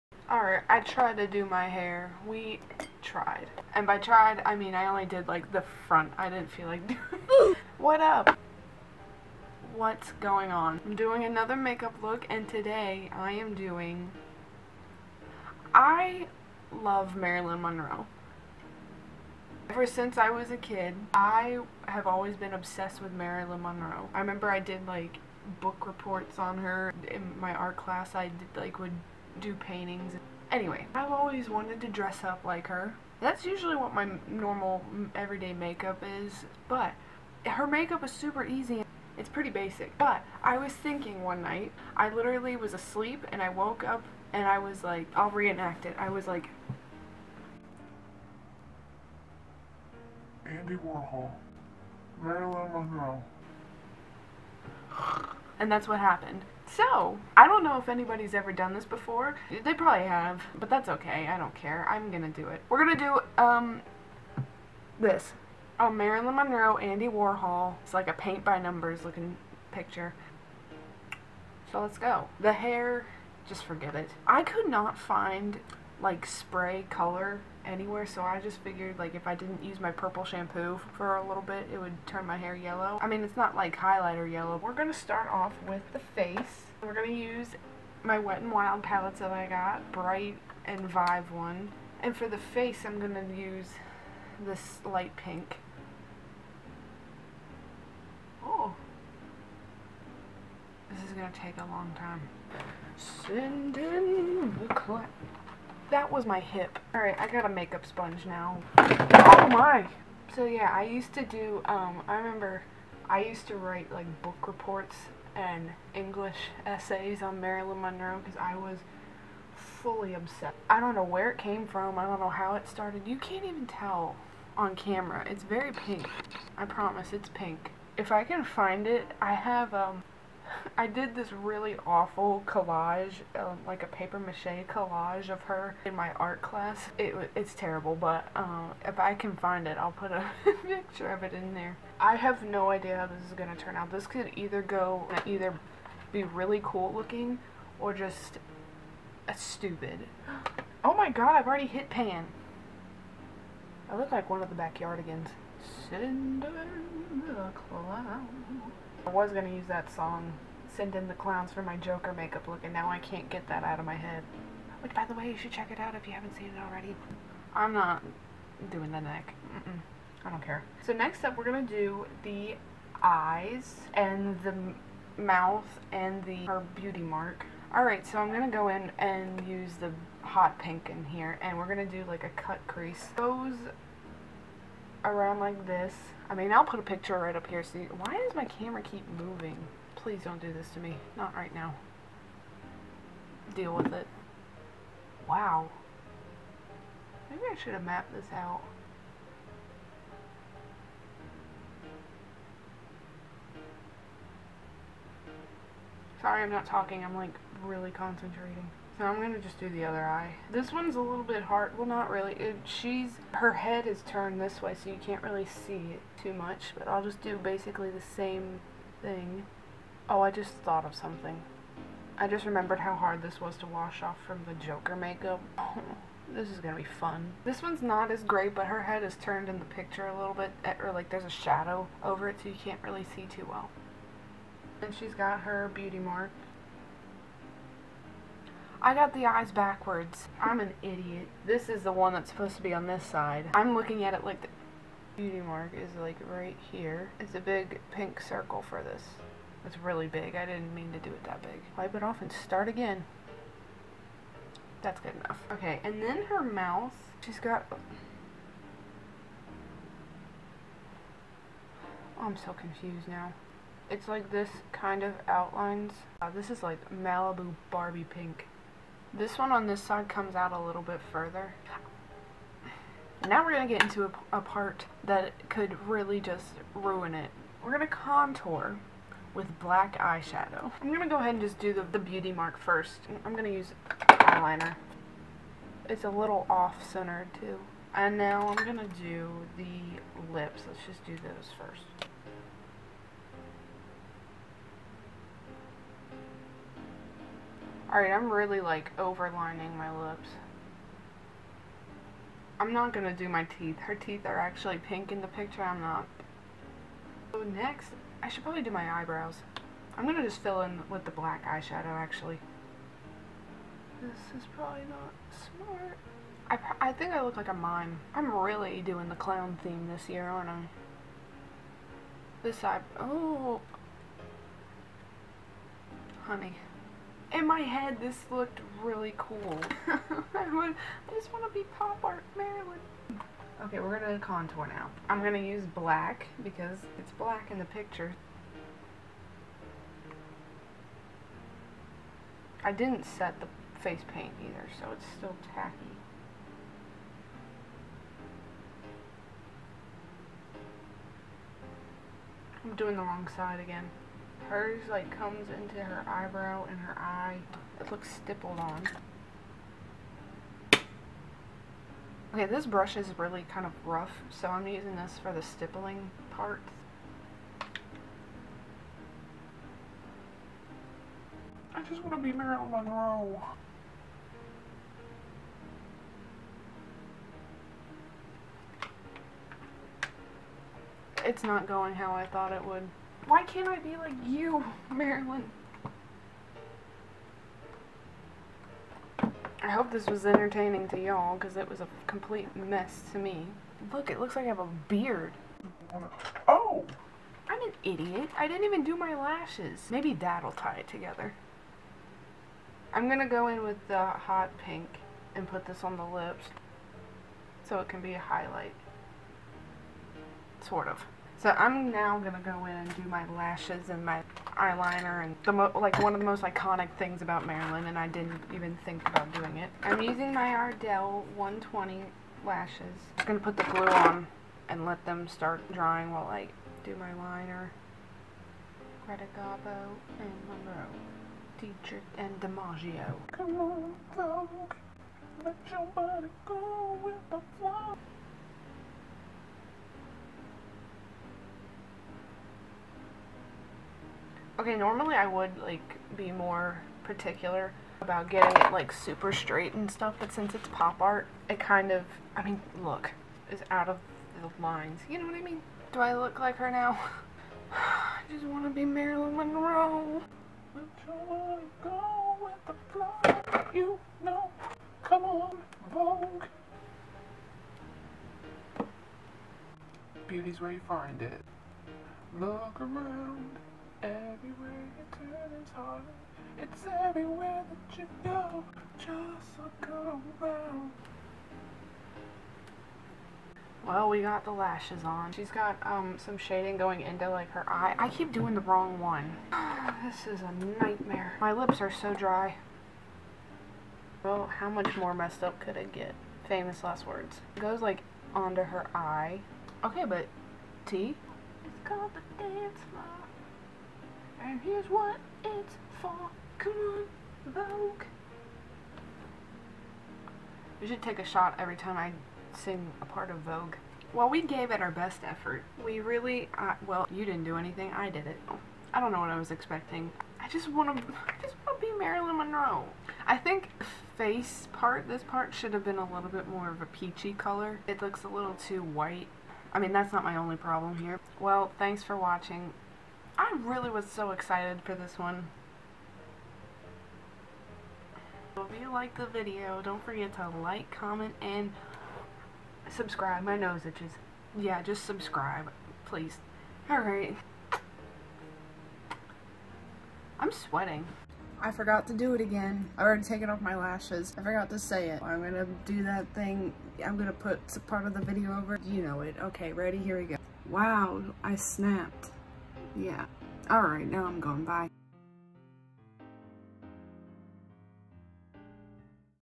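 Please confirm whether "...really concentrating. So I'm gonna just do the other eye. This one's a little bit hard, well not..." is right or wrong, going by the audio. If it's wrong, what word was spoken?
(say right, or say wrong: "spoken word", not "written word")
right.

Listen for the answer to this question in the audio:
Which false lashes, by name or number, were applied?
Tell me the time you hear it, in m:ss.
7:00.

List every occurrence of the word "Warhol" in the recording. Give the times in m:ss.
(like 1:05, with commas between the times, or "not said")
0:50, 1:07.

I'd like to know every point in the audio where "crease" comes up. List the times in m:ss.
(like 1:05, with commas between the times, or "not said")
3:02.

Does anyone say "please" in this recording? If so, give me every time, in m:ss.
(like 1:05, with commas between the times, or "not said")
3:10, 9:06.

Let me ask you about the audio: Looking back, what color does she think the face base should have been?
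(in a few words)
peachy.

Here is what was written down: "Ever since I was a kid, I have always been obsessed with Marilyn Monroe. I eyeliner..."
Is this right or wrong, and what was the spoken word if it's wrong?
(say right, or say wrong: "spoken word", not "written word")
wrong: "remember", not "eyeliner".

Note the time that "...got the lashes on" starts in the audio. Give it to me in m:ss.
8:04.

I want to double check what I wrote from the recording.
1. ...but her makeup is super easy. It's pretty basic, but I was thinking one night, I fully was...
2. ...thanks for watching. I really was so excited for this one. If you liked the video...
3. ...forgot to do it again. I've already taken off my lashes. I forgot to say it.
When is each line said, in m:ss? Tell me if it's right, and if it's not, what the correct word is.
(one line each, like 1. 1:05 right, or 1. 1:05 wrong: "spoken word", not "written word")
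1. 0:36 wrong: "literally", not "fully"
2. 8:51 right
3. 9:11 right.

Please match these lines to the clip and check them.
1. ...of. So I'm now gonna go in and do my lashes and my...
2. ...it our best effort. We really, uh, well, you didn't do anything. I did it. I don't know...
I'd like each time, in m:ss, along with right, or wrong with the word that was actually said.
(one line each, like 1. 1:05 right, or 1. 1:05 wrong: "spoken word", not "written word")
1. 6:50 right
2. 8:34 right.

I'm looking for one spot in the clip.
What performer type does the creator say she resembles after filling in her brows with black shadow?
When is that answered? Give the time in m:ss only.
5:17.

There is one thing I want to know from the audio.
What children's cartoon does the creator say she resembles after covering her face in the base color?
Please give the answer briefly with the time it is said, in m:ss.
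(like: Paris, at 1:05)
The Backyardigans, at 2:34.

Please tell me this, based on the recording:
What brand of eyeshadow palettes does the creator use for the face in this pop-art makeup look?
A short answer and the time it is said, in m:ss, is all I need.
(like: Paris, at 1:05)
Wet n Wild, at 1:28.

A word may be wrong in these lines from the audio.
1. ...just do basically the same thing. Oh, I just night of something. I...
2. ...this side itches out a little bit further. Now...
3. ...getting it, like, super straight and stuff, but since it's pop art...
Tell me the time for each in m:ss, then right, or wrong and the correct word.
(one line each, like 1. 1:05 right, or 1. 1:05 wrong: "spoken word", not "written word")
1. 3:37 wrong: "thought", not "night"
2. 4:29 wrong: "comes", not "itches"
3. 7:28 right.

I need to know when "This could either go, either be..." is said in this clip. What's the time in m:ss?
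2:23.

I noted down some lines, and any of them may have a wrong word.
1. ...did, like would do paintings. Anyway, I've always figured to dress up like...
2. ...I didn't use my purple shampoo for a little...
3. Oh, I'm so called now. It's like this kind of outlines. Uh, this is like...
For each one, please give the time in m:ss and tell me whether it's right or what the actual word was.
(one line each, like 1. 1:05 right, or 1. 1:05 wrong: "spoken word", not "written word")
1. 0:28 wrong: "wanted", not "figured"
2. 1:19 right
3. 4:17 wrong: "confused", not "called".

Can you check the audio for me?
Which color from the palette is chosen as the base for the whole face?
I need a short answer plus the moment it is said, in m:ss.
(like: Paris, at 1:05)
light pink, at 1:34.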